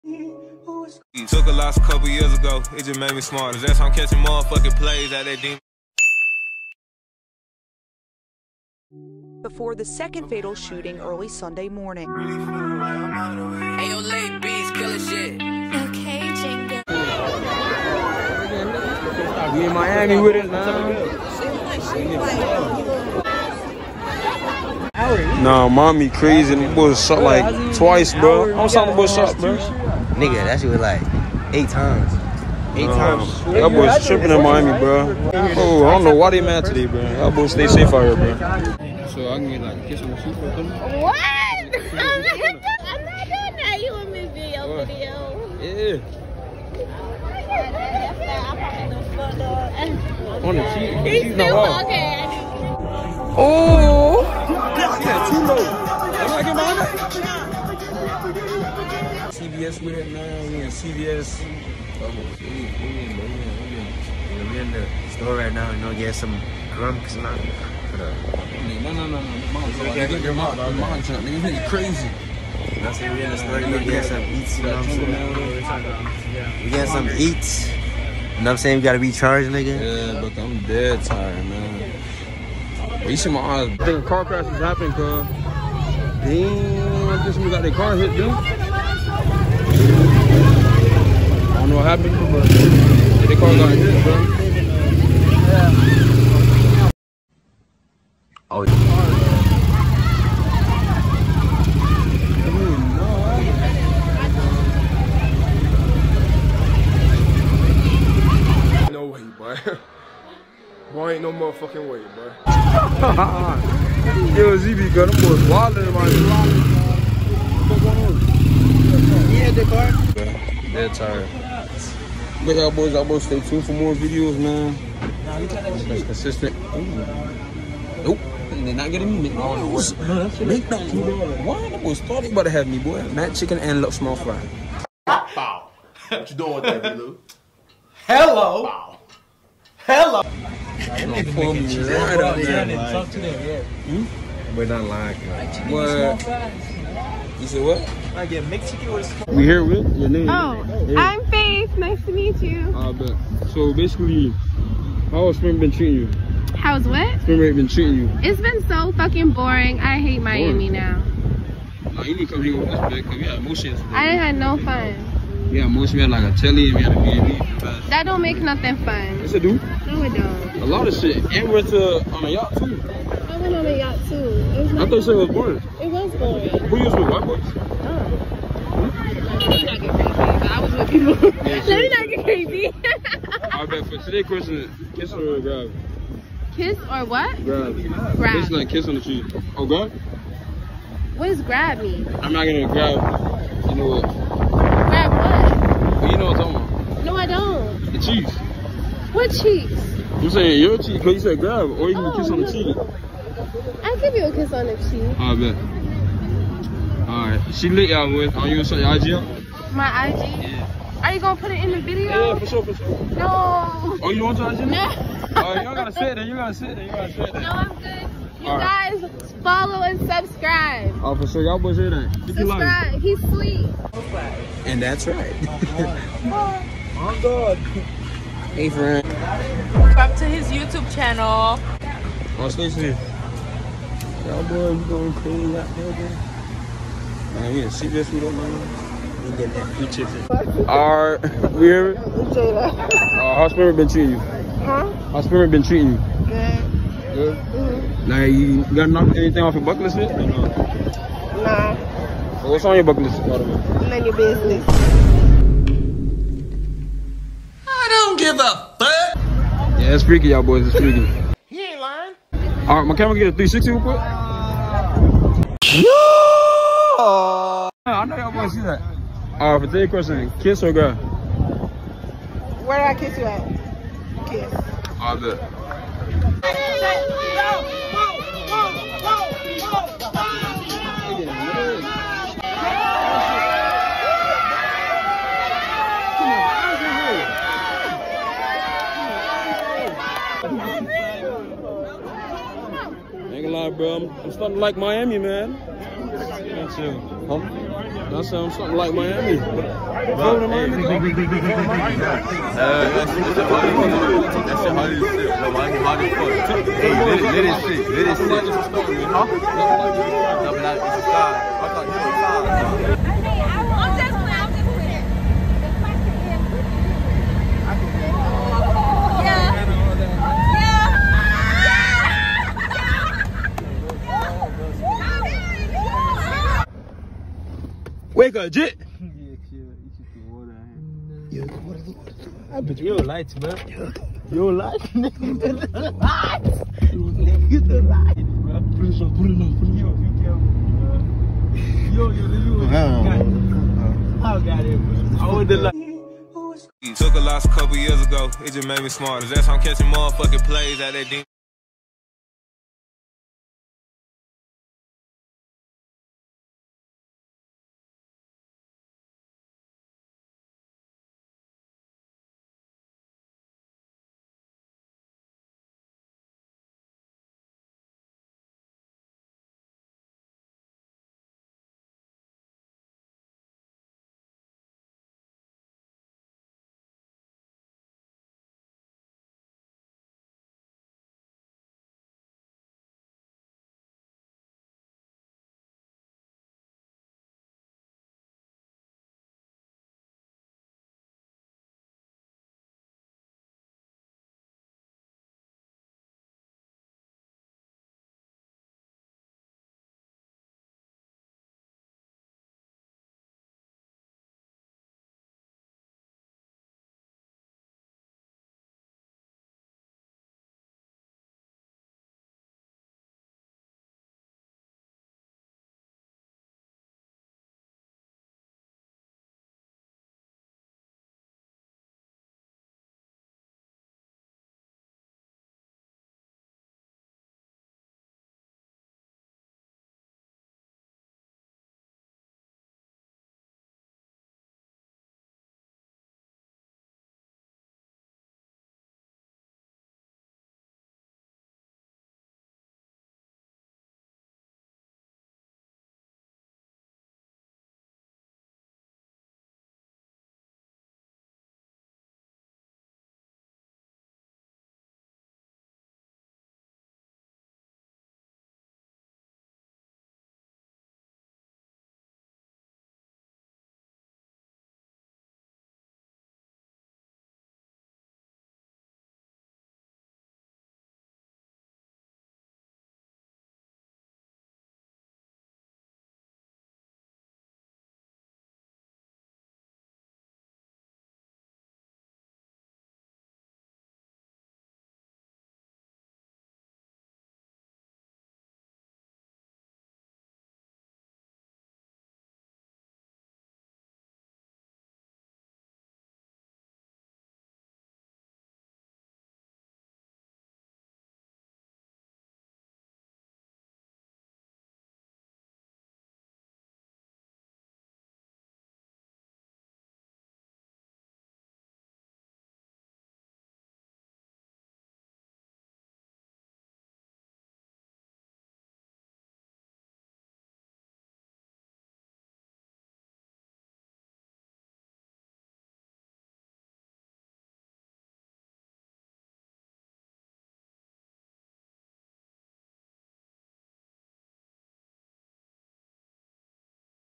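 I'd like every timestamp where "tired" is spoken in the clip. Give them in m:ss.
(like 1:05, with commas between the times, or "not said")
1:21, 2:00.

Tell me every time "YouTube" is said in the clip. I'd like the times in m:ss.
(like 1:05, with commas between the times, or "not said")
3:50.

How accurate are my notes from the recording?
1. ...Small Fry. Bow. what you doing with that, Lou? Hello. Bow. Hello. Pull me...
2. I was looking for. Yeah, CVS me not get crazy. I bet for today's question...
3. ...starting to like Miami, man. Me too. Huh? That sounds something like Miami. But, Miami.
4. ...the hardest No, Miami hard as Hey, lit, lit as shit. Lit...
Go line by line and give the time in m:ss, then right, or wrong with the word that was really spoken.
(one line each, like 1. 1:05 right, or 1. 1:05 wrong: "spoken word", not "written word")
1. 2:13 right
2. 3:00 wrong: "Let", not "CVS"
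3. 4:54 right
4. 5:04 right.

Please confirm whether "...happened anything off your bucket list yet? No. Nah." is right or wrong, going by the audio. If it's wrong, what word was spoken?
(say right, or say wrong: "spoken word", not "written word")
wrong: "knocked", not "happened".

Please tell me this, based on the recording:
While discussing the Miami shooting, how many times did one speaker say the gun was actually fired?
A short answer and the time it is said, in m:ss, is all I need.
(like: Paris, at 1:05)
8 times, at 0:31.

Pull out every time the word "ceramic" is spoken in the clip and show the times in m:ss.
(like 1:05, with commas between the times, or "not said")
not said.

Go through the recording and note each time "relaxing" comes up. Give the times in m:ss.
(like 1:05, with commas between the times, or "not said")
not said.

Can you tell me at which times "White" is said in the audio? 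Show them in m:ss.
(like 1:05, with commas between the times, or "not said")
2:57.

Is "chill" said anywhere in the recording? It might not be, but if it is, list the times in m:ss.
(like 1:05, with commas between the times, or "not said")
5:29.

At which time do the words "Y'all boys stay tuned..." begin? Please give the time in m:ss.
2:02.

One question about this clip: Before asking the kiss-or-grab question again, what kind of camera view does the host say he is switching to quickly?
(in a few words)
360.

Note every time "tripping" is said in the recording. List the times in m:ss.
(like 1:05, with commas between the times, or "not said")
0:34.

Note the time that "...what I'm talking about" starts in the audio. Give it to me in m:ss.
3:16.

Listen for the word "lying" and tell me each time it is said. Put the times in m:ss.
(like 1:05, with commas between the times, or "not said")
2:24, 4:21.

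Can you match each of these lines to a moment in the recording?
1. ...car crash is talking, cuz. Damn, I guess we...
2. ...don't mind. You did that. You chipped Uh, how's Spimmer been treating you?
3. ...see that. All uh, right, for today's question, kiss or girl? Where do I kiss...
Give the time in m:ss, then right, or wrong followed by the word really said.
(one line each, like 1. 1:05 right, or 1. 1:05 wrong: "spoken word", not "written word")
1. 1:24 wrong: "happening", not "talking"
2. 3:58 right
3. 4:28 right.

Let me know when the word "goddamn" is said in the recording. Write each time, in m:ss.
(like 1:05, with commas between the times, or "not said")
not said.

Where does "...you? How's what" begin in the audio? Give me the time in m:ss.
2:35.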